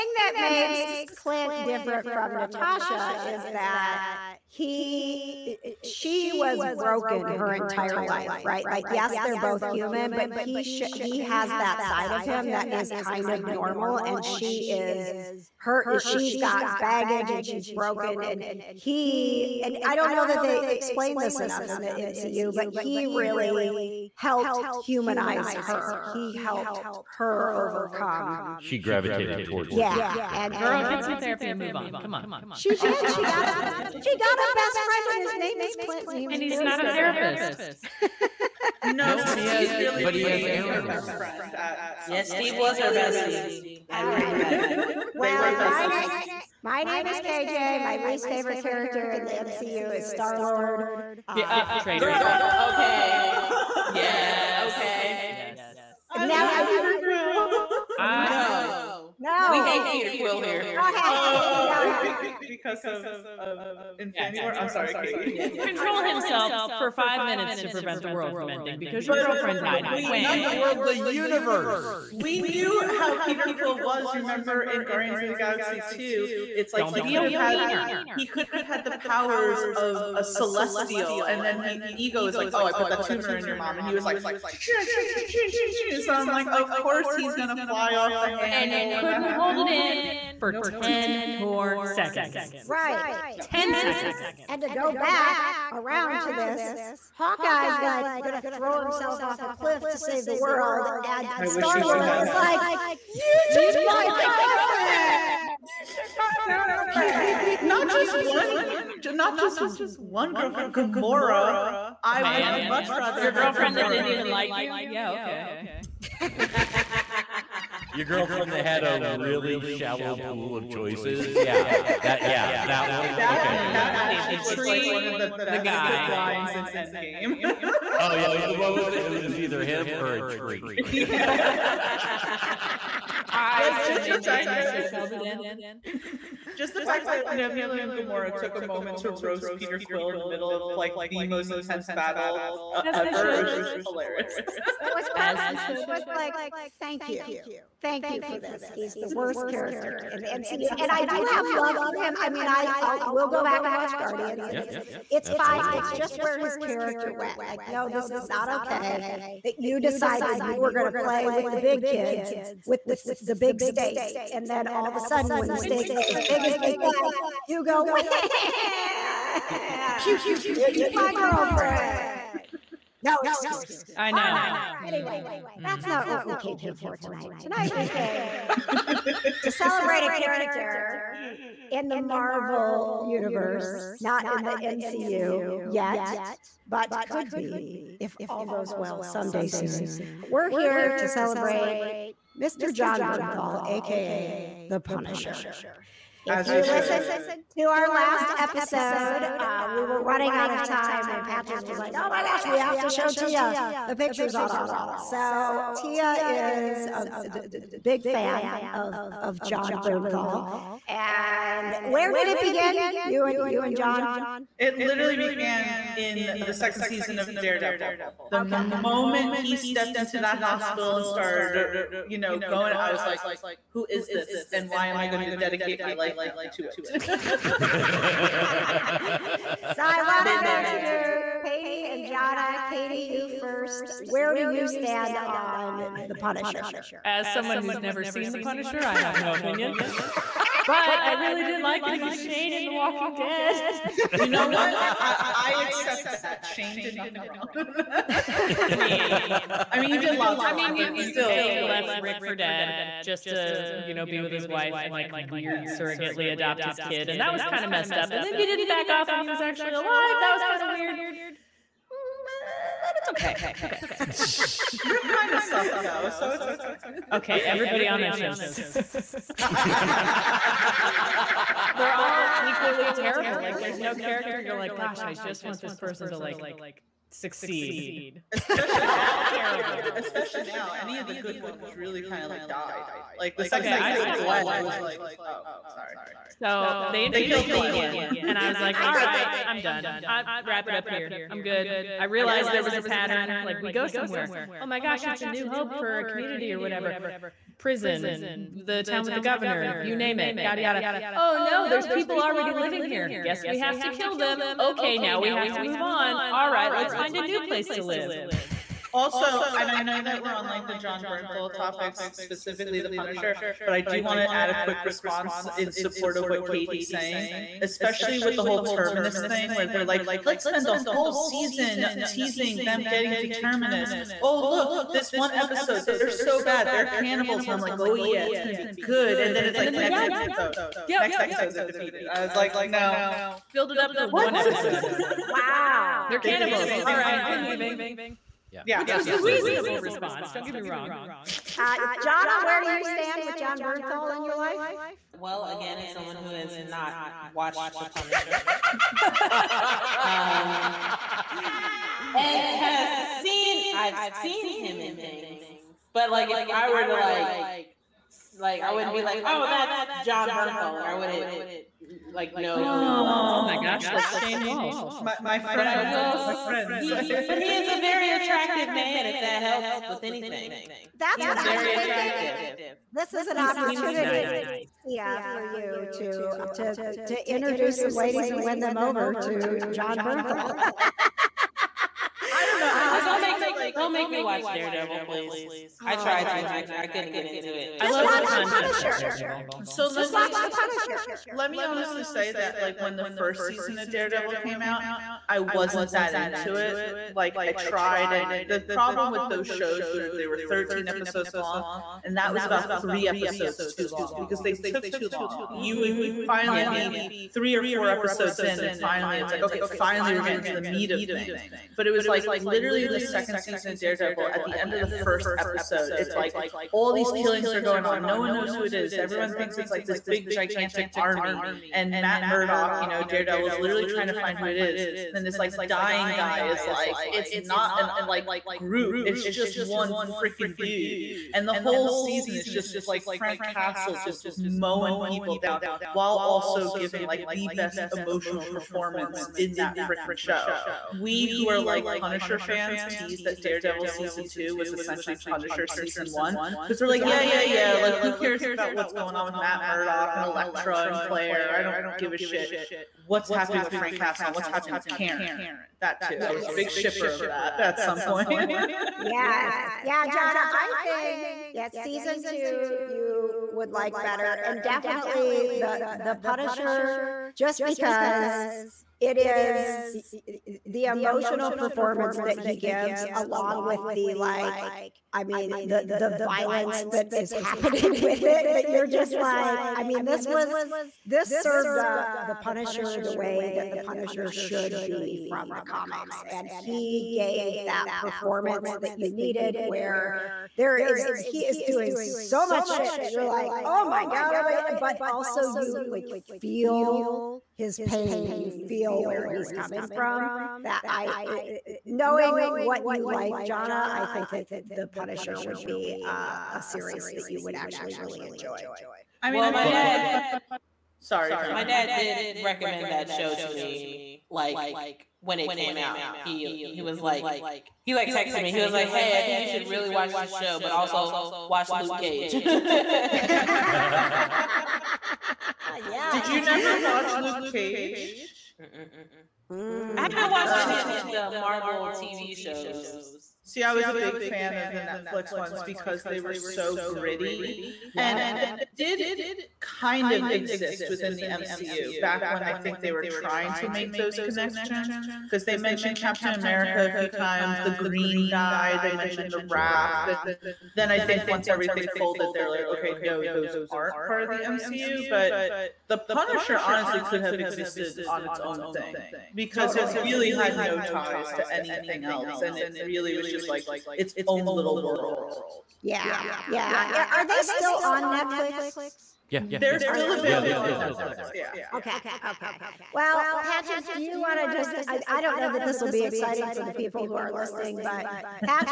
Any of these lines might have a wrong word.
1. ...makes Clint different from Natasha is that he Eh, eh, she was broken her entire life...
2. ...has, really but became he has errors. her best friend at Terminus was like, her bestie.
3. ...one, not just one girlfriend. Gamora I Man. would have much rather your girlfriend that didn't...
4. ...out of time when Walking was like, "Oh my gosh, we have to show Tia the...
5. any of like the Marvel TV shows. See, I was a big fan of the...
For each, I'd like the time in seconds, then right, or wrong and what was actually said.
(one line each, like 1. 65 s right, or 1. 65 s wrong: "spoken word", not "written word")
1. 0 s right
2. 39 s wrong: "Steve", not "Terminus"
3. 108 s right
4. 200 s wrong: "Patches", not "Walking"
5. 530 s right.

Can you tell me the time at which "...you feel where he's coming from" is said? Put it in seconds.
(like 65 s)
498 s.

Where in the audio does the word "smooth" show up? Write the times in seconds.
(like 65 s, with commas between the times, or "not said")
not said.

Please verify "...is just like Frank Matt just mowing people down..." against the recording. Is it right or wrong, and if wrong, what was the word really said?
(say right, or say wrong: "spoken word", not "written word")
wrong: "Castle", not "Matt".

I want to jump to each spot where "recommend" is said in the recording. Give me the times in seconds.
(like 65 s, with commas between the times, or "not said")
512 s.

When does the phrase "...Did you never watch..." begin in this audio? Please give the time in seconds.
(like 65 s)
526 s.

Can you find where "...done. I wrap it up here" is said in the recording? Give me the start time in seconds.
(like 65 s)
289 s.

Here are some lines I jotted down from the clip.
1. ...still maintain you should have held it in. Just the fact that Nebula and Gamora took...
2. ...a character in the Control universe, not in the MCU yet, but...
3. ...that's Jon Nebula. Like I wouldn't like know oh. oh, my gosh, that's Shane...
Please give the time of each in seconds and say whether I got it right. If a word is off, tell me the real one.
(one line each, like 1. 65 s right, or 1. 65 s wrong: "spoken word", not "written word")
1. 133 s right
2. 180 s wrong: "Marvel", not "Control"
3. 359 s wrong: "Bernthal", not "Nebula".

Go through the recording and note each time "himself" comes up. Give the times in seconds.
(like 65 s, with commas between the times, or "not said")
66 s, 98 s.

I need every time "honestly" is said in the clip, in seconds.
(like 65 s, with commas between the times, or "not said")
391 s, 556 s.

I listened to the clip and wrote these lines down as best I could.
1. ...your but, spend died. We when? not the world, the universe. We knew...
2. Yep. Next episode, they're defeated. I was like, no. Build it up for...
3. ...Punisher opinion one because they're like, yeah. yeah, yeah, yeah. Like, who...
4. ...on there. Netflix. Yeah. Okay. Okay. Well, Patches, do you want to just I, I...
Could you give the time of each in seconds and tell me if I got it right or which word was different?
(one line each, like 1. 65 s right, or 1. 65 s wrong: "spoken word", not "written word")
1. 69 s wrong: "girlfriend", not "spend"
2. 330 s right
3. 445 s wrong: "season", not "opinion"
4. 570 s right.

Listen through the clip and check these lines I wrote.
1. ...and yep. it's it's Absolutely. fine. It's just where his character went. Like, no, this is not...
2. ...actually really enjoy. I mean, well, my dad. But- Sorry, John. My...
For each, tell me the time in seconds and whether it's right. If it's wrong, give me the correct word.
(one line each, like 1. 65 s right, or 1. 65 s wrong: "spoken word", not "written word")
1. 154 s right
2. 507 s right.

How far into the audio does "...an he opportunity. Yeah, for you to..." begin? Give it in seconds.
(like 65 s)
373 s.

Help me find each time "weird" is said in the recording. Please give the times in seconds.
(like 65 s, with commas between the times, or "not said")
255 s, 260 s.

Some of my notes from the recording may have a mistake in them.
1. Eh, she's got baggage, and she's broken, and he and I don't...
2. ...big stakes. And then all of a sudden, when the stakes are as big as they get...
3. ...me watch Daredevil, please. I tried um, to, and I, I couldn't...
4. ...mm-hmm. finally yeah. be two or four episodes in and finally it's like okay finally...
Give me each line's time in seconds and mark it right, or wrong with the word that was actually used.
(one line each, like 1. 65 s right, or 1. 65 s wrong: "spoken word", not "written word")
1. 15 s right
2. 163 s right
3. 384 s right
4. 405 s wrong: "three", not "two".